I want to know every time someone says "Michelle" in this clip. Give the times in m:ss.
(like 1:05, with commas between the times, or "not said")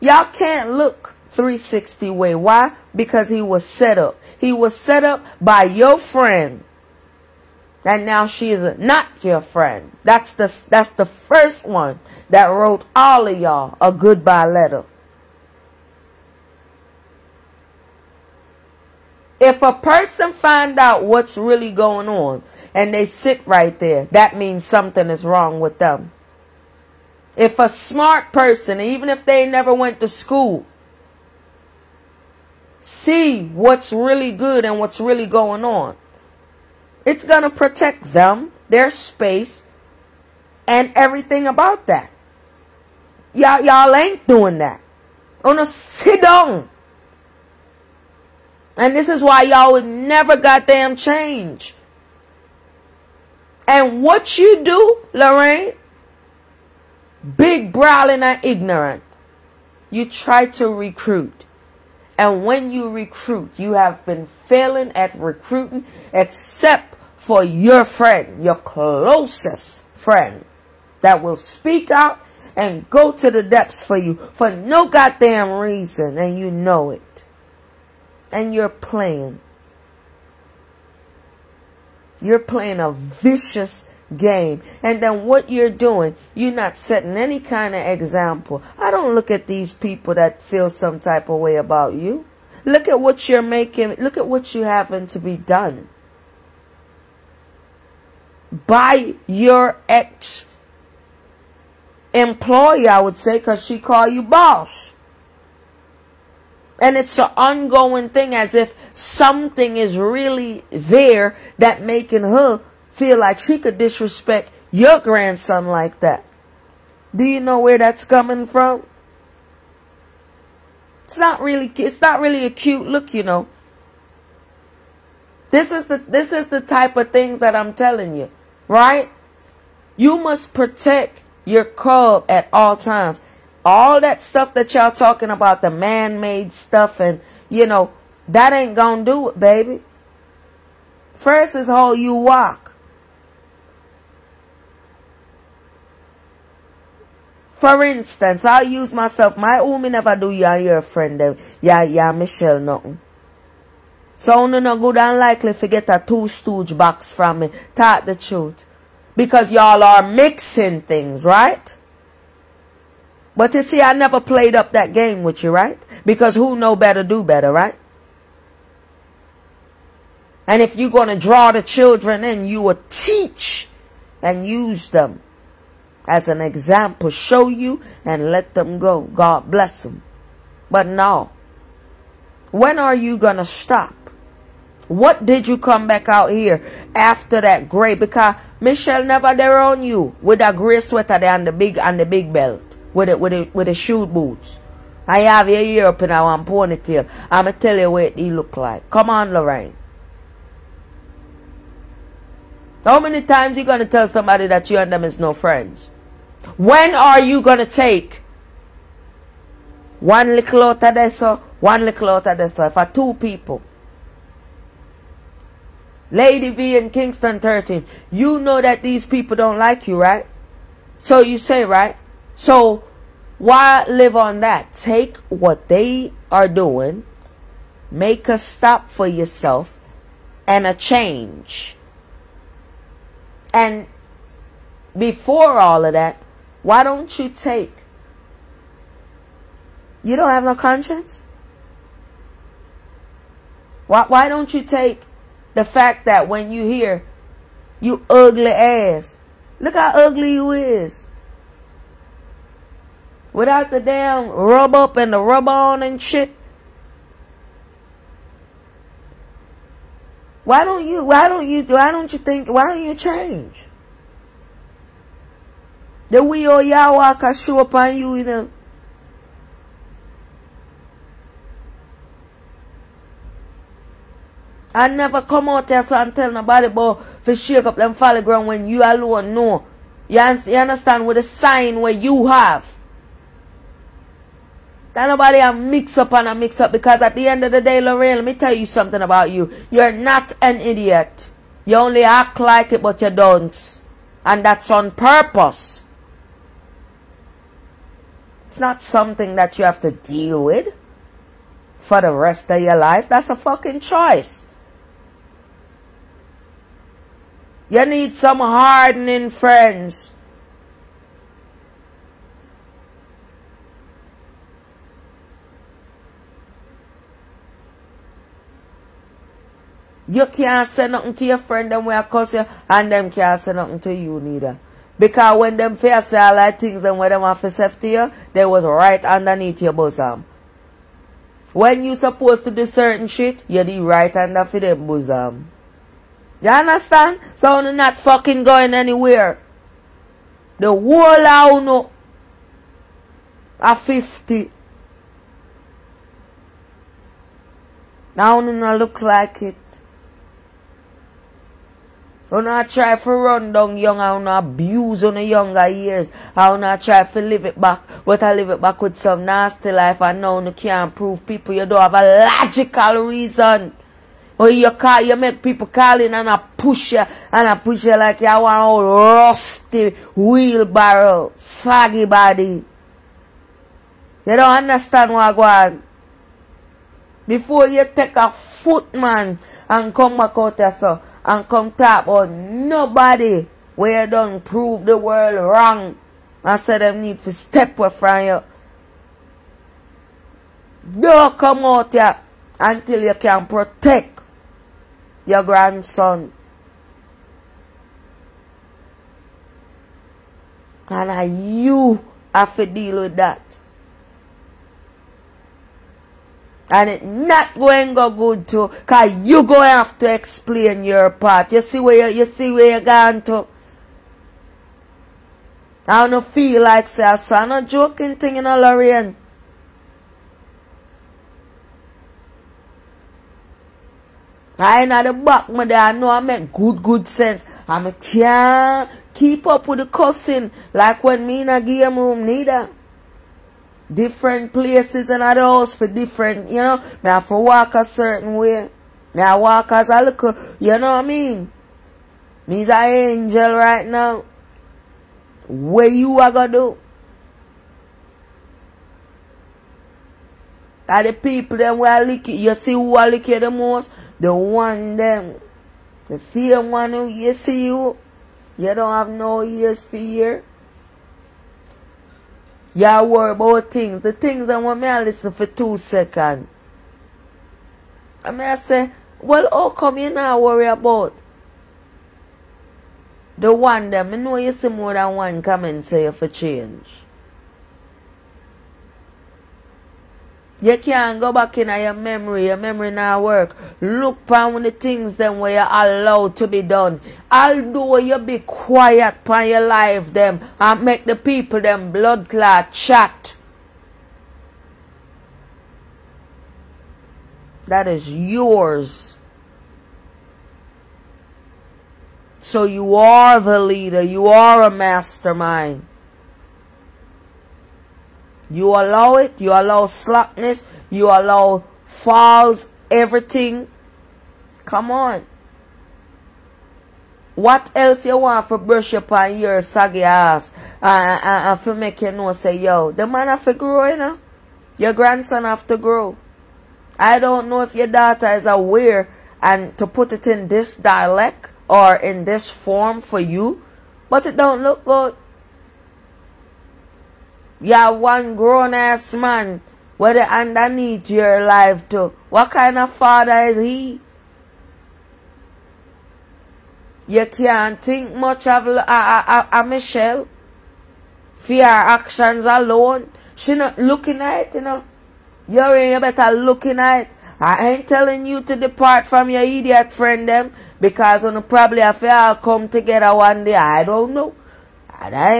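2:32, 3:08, 9:09.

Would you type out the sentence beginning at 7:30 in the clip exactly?
Are the people them where lick you, you see who I lick you the most?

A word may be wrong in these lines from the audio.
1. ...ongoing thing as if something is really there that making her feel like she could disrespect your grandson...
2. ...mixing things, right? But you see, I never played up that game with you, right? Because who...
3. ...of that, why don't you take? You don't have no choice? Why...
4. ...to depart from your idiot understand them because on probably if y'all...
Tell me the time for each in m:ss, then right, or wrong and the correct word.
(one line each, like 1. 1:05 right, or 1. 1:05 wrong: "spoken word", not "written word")
1. 1:47 right
2. 2:40 right
3. 3:55 wrong: "conscience", not "choice"
4. 9:18 wrong: "friend", not "understand".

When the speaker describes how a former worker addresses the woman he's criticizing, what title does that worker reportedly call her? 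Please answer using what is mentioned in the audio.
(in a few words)
boss.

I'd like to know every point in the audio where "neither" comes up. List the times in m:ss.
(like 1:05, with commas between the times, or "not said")
5:24, 7:12.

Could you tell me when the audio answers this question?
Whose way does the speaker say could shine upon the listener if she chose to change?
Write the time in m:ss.
4:26.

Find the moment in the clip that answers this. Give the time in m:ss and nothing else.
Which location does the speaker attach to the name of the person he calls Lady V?
3:36.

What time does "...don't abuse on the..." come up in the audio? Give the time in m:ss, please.
5:54.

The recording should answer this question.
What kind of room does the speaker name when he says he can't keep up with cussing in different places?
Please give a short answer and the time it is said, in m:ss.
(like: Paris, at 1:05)
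game room, at 7:11.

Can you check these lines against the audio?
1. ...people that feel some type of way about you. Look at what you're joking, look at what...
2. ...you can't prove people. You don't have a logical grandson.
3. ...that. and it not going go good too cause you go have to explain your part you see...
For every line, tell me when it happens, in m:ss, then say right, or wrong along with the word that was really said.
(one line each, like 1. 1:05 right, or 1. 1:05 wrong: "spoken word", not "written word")
1. 1:29 wrong: "making", not "joking"
2. 6:00 wrong: "reason", not "grandson"
3. 6:43 right.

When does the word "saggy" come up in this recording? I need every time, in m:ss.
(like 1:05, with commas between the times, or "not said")
6:11, 8:39.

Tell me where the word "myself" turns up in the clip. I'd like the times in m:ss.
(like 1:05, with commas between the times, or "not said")
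2:28.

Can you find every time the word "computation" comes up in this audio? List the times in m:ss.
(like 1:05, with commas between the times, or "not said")
not said.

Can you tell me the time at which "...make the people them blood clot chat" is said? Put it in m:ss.
8:10.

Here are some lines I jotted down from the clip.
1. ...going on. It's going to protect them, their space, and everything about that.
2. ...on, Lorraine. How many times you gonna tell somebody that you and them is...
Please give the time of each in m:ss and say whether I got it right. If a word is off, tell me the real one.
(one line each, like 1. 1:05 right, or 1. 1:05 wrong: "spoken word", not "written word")
1. 0:35 right
2. 3:19 right.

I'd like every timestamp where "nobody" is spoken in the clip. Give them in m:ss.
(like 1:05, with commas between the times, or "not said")
4:36, 4:45, 6:22.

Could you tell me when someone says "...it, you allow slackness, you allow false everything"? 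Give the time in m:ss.
8:29.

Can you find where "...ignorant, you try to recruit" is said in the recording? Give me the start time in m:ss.
0:58.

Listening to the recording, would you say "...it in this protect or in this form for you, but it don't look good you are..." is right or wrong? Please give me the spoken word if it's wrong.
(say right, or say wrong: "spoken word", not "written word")
wrong: "dialect", not "protect".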